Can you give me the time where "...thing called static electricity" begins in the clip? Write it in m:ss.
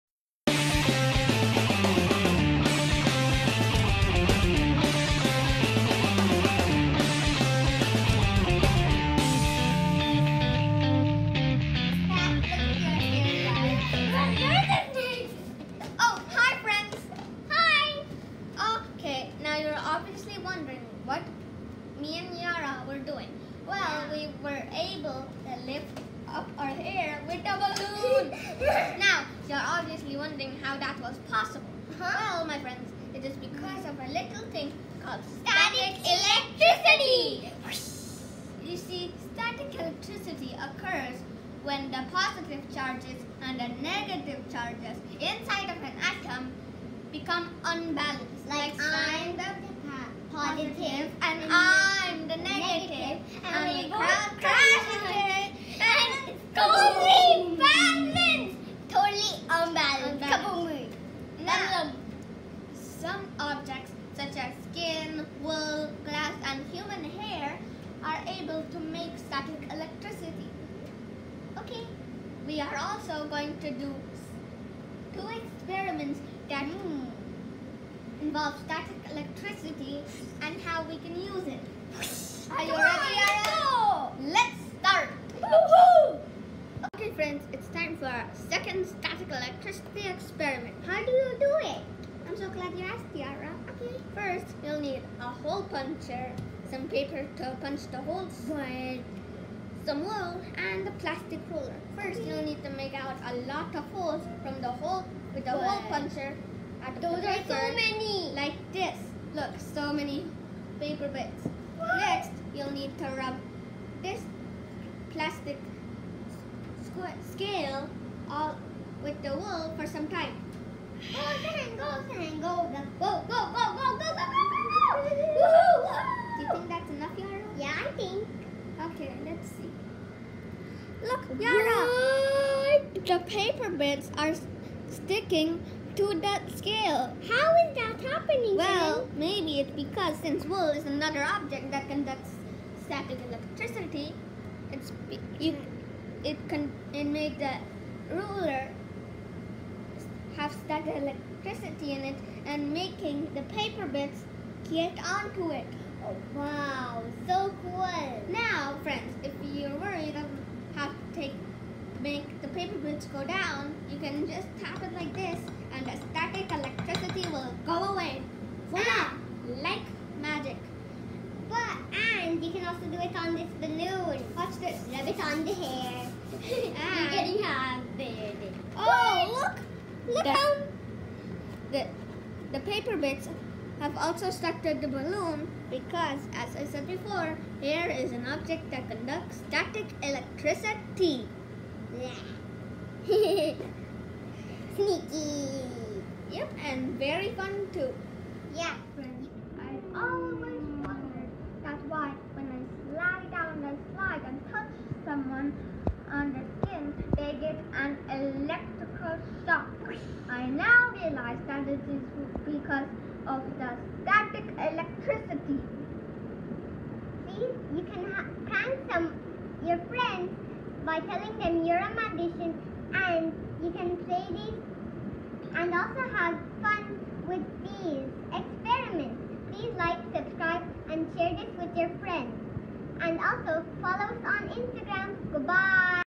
0:34.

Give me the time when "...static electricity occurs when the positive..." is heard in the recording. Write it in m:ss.
0:39.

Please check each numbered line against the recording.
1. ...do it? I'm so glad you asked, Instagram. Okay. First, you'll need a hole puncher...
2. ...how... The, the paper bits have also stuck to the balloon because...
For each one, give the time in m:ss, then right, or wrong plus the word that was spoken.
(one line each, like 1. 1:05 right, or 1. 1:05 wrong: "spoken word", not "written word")
1. 1:31 wrong: "Tiara", not "Instagram"
2. 3:00 right.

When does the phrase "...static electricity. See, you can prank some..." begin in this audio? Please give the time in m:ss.
3:34.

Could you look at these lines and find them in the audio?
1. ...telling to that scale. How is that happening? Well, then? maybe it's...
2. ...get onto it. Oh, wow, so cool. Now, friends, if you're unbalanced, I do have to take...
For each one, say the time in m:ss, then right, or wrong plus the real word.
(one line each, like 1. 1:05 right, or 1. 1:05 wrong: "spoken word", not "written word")
1. 2:14 wrong: "sticking", not "telling"
2. 2:34 wrong: "worried", not "unbalanced".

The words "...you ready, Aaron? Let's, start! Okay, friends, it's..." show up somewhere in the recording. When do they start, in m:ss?
1:22.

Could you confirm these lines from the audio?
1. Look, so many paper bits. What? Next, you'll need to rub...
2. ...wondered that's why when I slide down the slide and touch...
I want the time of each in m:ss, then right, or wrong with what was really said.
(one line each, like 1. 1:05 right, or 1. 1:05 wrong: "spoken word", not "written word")
1. 1:49 right
2. 3:20 right.